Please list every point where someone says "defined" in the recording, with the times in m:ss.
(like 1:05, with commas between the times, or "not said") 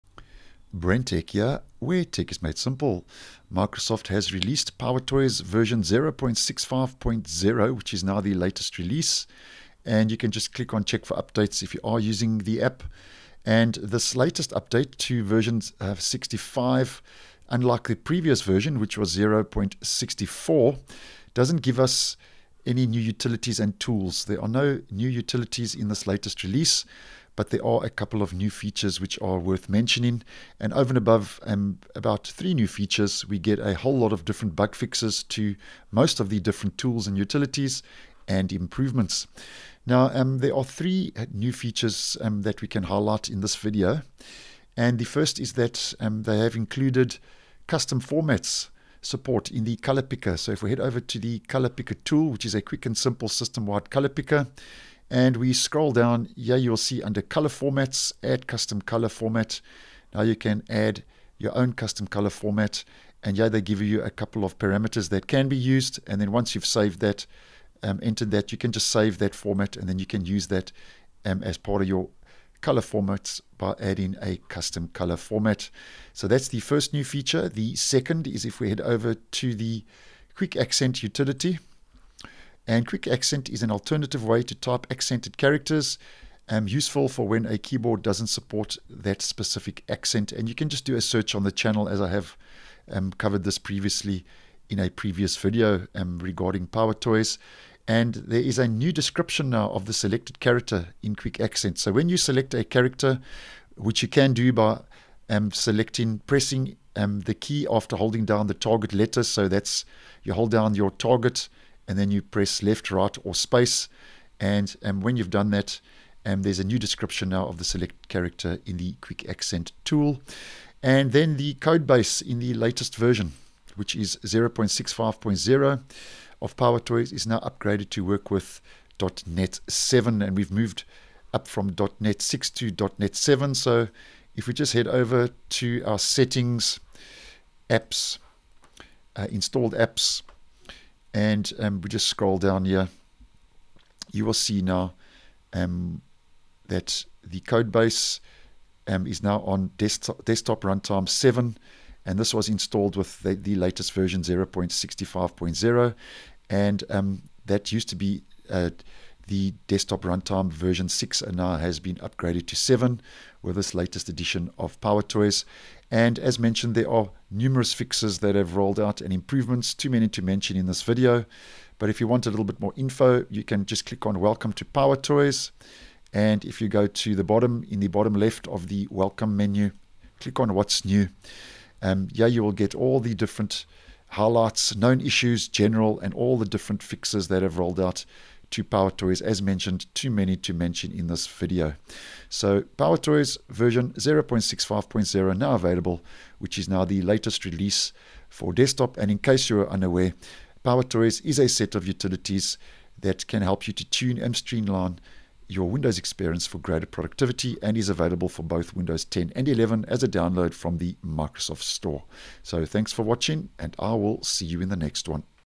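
not said.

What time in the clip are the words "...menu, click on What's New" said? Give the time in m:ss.
2:59.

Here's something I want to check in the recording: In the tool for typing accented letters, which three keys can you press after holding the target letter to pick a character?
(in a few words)
left, right, or space.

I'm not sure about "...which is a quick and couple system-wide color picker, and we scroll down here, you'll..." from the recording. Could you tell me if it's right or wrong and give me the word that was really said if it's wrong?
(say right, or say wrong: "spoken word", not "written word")
wrong: "simple", not "couple".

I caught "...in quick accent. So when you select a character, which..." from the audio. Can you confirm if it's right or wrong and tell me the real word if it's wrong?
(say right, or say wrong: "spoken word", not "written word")
right.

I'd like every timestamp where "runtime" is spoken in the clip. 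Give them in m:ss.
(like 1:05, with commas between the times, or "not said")
2:30, 2:40.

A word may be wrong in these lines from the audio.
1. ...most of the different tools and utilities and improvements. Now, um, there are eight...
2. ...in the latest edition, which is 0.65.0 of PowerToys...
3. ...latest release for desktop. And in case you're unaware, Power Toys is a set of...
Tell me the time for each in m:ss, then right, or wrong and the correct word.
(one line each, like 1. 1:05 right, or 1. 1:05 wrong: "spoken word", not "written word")
1. 0:35 wrong: "three", not "eight"
2. 2:02 wrong: "version", not "edition"
3. 3:17 right.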